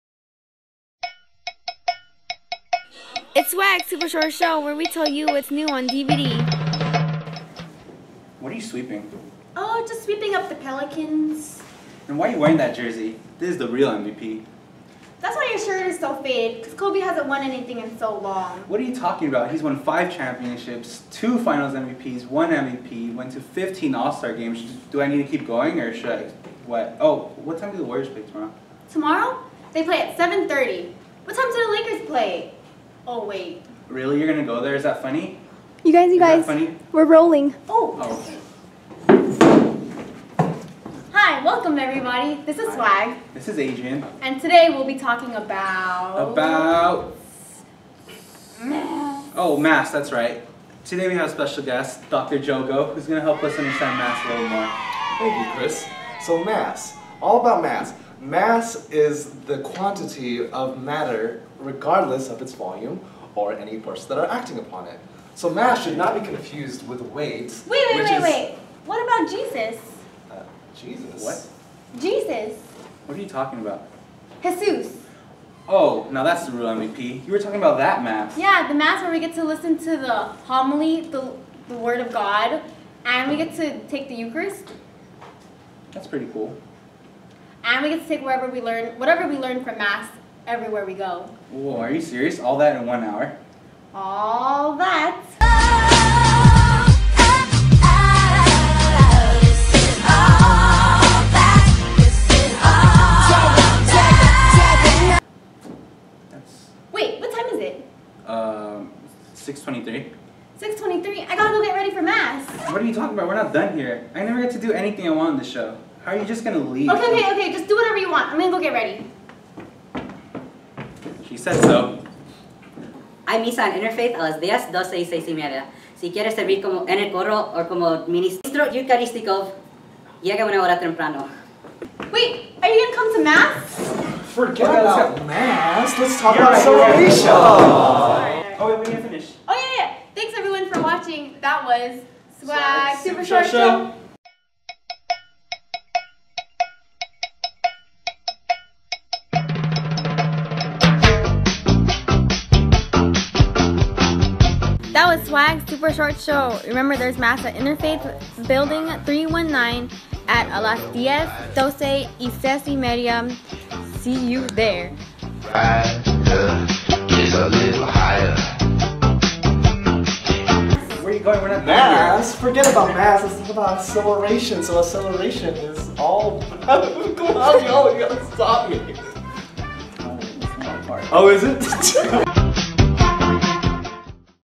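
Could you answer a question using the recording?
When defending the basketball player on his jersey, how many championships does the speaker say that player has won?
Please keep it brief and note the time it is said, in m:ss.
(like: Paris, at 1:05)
5, at 0:19.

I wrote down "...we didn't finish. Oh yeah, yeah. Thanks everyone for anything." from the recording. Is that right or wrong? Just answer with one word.
wrong.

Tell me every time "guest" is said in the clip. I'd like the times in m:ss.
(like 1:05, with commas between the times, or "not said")
0:51.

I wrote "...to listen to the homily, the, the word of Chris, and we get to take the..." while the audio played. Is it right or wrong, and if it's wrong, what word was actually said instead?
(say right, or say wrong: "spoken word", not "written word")
wrong: "God", not "Chris".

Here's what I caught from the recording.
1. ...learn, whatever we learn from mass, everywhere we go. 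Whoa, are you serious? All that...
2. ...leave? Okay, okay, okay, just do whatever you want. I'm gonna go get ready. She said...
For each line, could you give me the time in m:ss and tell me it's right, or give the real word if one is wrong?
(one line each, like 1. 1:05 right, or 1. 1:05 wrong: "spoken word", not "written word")
1. 1:28 right
2. 1:56 right.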